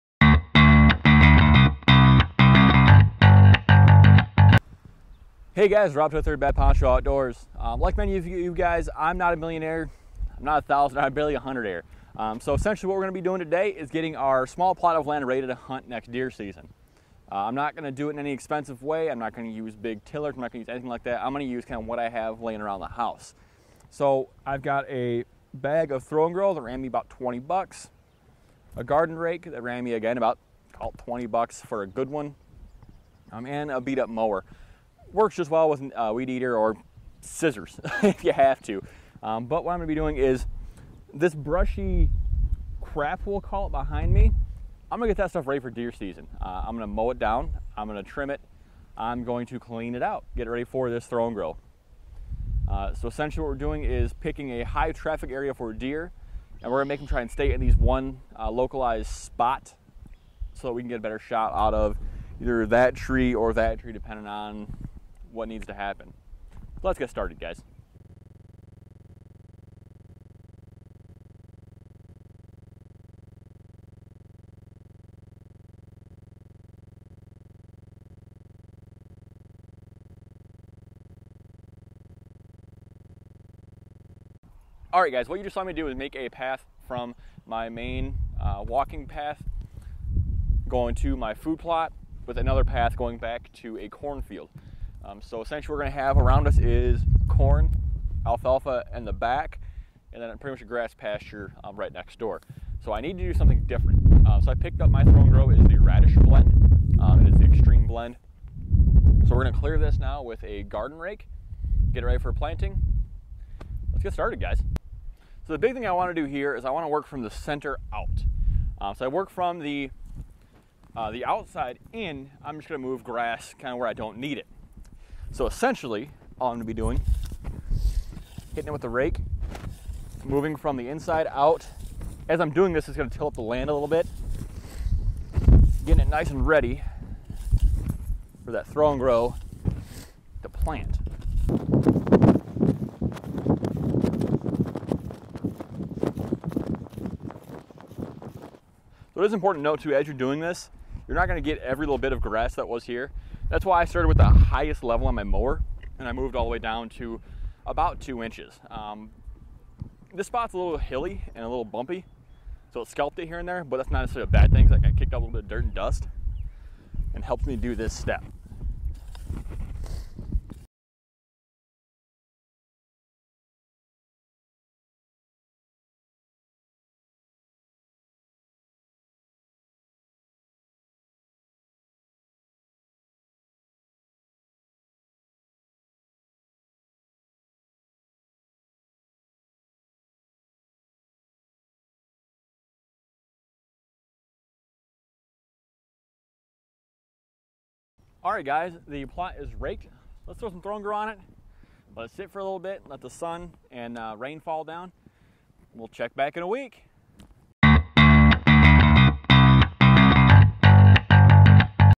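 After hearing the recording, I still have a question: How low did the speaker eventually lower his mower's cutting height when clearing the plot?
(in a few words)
2 inches.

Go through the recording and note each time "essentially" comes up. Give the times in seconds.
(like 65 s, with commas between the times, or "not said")
12 s, 53 s, 95 s, 125 s.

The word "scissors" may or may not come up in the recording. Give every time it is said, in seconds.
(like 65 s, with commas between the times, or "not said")
37 s.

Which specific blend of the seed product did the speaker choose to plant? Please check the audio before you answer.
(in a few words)
radish blend.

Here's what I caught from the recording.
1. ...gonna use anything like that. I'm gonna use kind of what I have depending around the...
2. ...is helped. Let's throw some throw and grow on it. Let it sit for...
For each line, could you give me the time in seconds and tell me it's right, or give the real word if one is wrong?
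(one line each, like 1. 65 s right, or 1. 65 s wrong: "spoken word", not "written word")
1. 20 s wrong: "laying", not "depending"
2. 199 s wrong: "raked", not "helped".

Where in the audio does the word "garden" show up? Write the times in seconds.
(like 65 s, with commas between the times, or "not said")
28 s, 110 s.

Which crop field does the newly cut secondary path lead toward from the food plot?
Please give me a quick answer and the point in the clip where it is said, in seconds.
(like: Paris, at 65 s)
cornfield, at 93 s.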